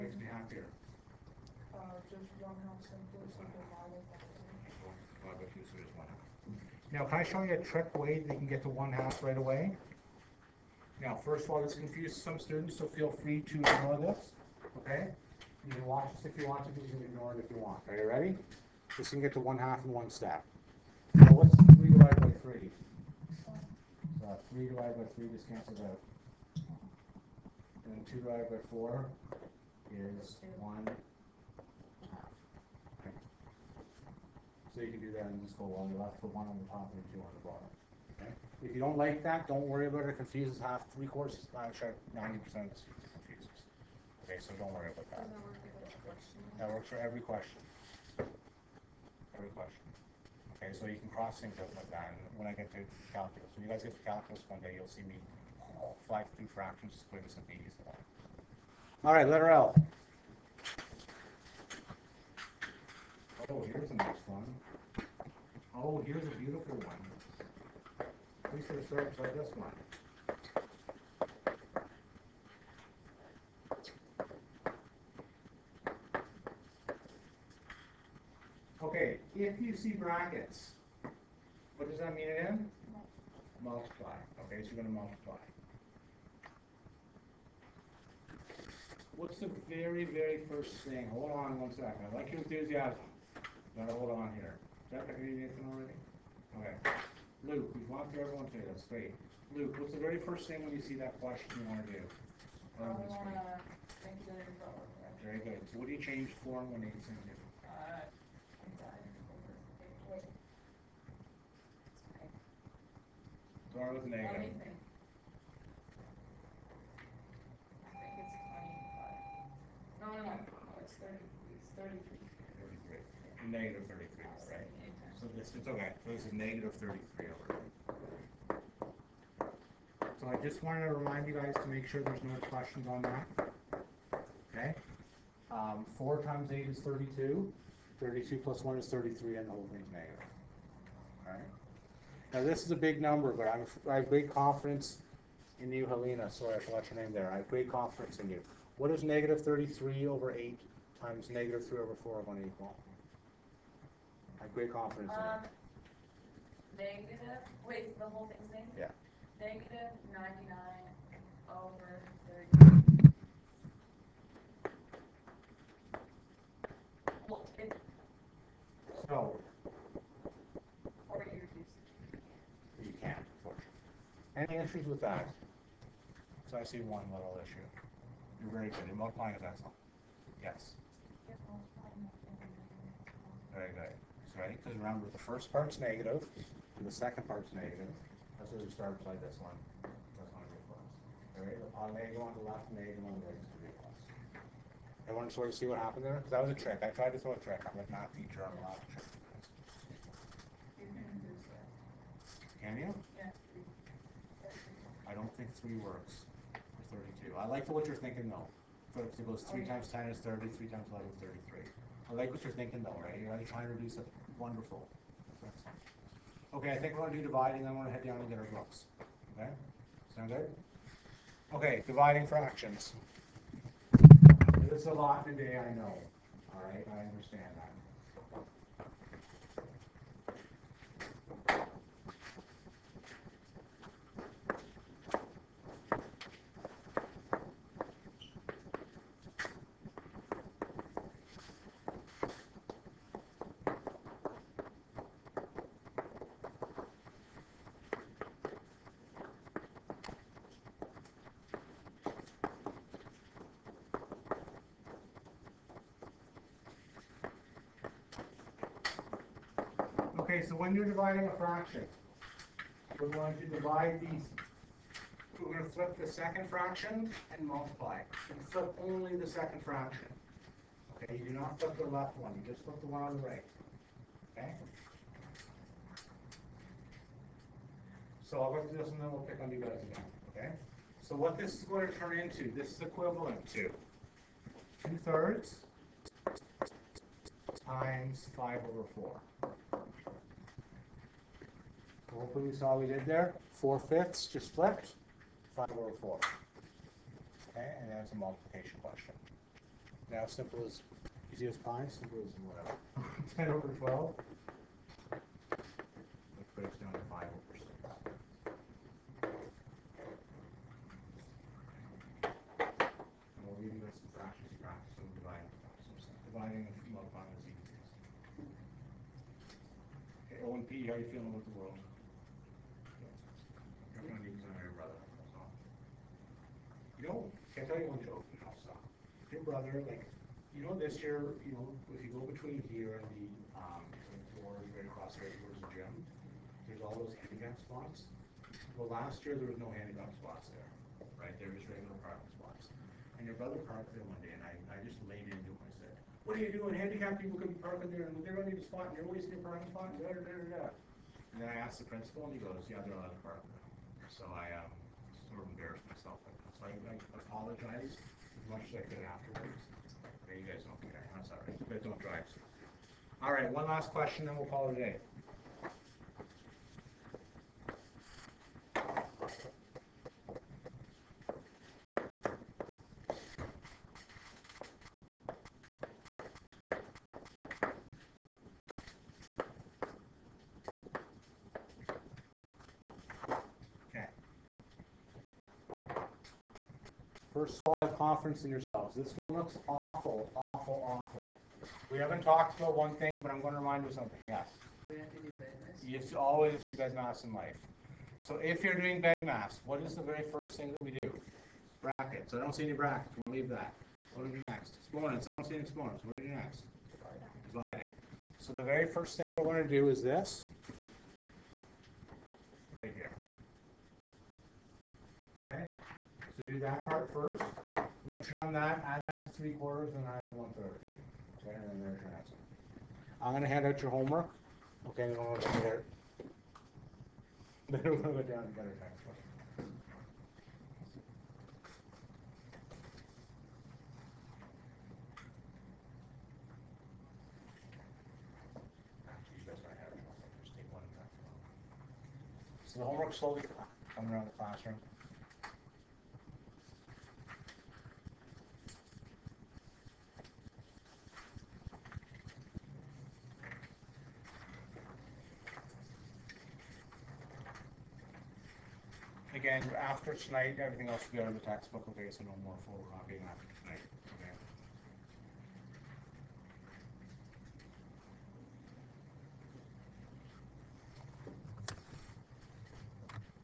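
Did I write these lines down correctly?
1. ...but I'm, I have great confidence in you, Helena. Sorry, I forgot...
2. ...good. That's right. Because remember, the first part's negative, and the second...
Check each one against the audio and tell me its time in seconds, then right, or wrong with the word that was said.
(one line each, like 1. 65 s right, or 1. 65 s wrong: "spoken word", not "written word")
1. 143 s right
2. 183 s right.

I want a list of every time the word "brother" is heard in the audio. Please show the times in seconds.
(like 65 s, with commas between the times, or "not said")
329 s, 343 s.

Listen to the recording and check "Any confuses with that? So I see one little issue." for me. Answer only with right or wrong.
wrong.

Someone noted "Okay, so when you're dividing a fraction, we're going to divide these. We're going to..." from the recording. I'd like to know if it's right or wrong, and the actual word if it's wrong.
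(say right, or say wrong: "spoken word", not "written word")
right.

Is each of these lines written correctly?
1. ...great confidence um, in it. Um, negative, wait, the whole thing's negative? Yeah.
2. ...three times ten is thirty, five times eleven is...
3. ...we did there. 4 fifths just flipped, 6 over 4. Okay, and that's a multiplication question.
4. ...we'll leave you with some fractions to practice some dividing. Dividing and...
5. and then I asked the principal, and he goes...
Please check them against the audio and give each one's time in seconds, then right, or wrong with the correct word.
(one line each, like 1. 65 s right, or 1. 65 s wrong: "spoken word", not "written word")
1. 154 s right
2. 209 s wrong: "three", not "five"
3. 292 s wrong: "5", not "6"
4. 313 s right
5. 351 s right.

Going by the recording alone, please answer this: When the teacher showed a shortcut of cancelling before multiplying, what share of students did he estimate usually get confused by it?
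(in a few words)
90%.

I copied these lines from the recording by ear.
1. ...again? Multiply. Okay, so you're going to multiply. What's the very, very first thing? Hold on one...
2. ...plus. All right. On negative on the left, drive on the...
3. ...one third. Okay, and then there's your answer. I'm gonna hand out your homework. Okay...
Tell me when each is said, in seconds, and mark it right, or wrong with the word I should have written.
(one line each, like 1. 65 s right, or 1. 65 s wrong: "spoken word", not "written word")
1. 82 s right
2. 190 s wrong: "negative", not "drive"
3. 420 s right.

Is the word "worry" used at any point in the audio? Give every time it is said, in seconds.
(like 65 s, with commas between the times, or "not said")
39 s, 44 s.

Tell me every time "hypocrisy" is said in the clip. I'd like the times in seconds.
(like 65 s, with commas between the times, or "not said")
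not said.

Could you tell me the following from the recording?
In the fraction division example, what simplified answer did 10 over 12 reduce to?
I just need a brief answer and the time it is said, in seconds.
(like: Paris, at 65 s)
5 over 6, at 307 s.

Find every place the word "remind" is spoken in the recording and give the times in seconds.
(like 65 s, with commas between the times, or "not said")
130 s, 393 s.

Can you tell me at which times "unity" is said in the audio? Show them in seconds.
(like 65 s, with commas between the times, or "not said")
not said.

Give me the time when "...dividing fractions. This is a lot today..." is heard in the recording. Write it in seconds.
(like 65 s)
221 s.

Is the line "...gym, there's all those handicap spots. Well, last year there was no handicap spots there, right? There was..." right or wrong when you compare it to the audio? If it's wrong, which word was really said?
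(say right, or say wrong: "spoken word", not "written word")
right.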